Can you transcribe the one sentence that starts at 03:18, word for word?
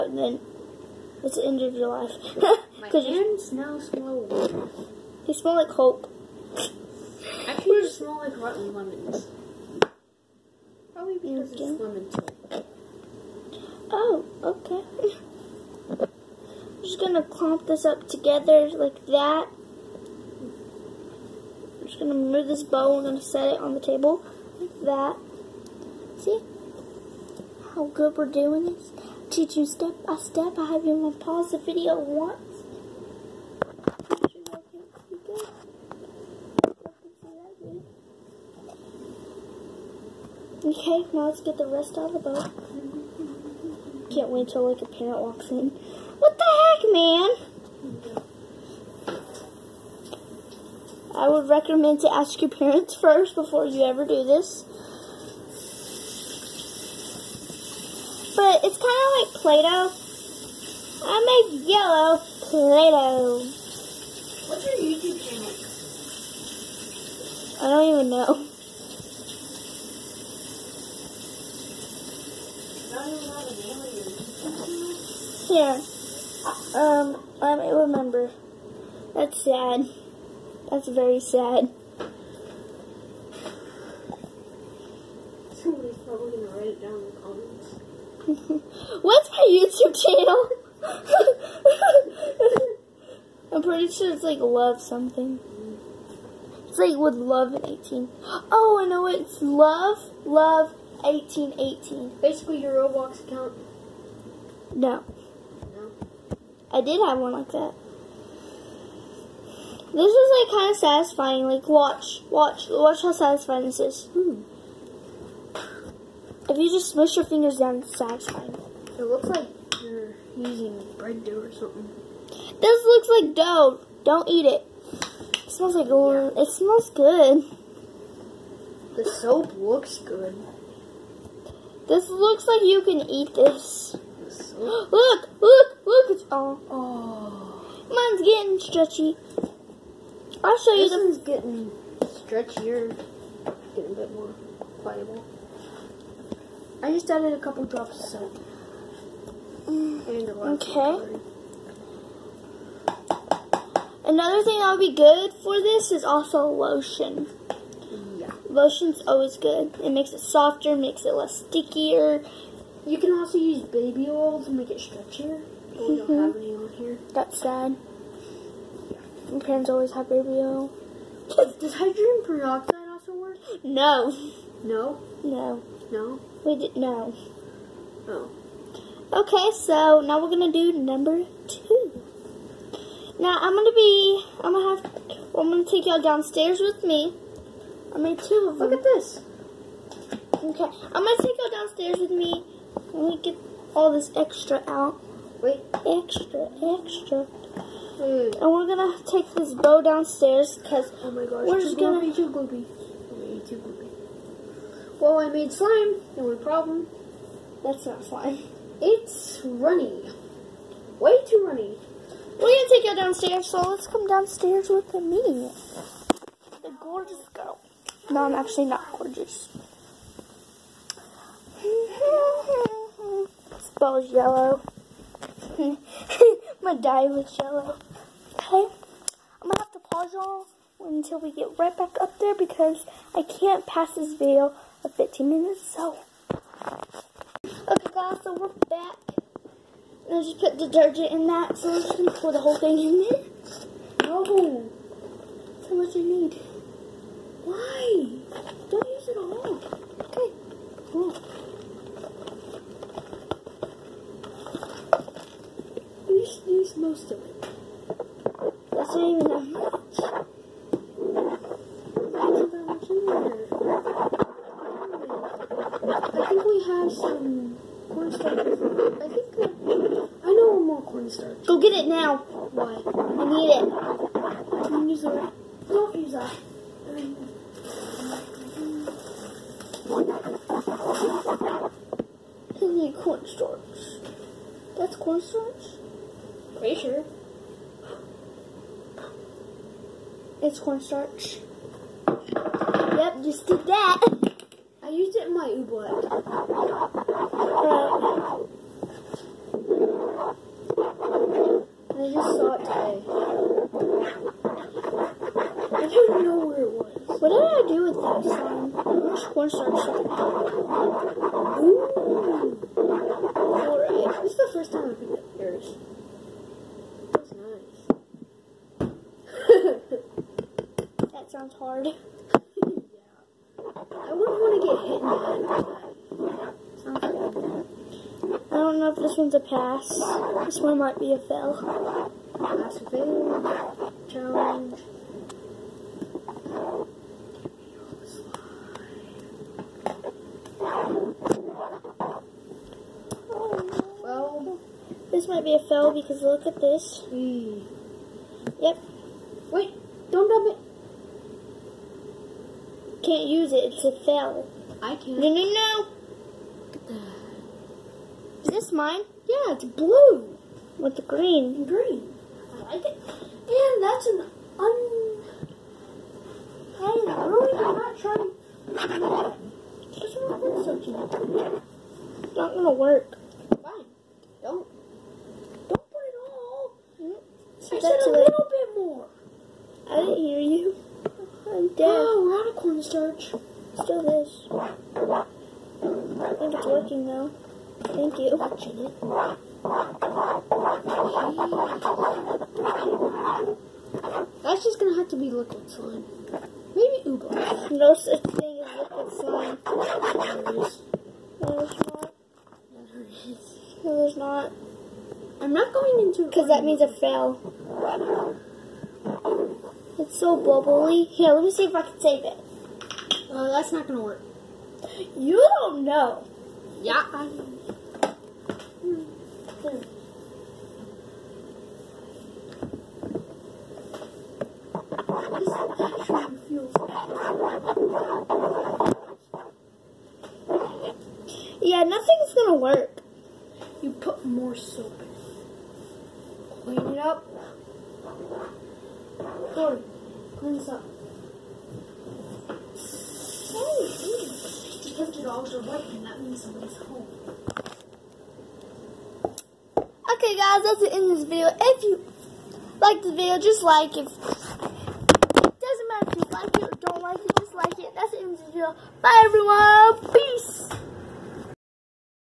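And we're gonna take this bow downstairs because oh my gosh, we're just gonna be too gloopy.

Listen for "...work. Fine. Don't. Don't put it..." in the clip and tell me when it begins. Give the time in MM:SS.
06:12.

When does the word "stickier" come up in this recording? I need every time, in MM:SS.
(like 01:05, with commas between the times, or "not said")
02:41.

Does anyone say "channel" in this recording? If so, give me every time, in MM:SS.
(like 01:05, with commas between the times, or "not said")
01:05, 01:30.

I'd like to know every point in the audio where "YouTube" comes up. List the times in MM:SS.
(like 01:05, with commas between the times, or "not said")
01:04, 01:29.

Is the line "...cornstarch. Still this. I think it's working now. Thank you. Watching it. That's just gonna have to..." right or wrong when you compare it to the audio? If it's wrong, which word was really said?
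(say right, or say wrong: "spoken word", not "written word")
right.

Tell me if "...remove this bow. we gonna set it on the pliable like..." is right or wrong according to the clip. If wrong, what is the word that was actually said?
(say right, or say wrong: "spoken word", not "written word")
wrong: "table", not "pliable".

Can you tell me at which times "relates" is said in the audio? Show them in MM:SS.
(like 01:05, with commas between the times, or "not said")
not said.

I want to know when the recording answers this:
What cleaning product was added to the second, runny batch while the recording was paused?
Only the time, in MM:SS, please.
04:00.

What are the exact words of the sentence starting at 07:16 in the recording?
Clean it up clean this up.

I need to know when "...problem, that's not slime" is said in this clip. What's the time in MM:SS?
03:26.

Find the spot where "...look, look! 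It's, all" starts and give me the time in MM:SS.
02:15.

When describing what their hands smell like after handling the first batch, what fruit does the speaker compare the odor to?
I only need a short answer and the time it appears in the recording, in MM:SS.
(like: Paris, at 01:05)
rotten lemons, at 00:08.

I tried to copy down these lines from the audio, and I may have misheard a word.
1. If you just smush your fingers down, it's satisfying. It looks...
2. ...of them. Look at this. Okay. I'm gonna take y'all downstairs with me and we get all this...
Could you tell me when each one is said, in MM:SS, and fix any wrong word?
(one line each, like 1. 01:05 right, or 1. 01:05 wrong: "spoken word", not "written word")
1. 01:56 right
2. 03:08 right.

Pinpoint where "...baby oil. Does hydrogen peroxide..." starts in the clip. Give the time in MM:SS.
02:50.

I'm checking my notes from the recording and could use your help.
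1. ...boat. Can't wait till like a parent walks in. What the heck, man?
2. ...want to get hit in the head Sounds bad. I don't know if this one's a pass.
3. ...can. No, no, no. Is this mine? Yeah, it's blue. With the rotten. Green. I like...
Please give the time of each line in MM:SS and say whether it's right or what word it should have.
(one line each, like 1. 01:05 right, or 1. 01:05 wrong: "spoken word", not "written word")
1. 00:42 right
2. 05:24 right
3. 05:54 wrong: "green", not "rotten".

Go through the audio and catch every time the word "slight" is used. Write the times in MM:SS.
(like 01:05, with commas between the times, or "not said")
not said.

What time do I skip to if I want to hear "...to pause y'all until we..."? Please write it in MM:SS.
03:49.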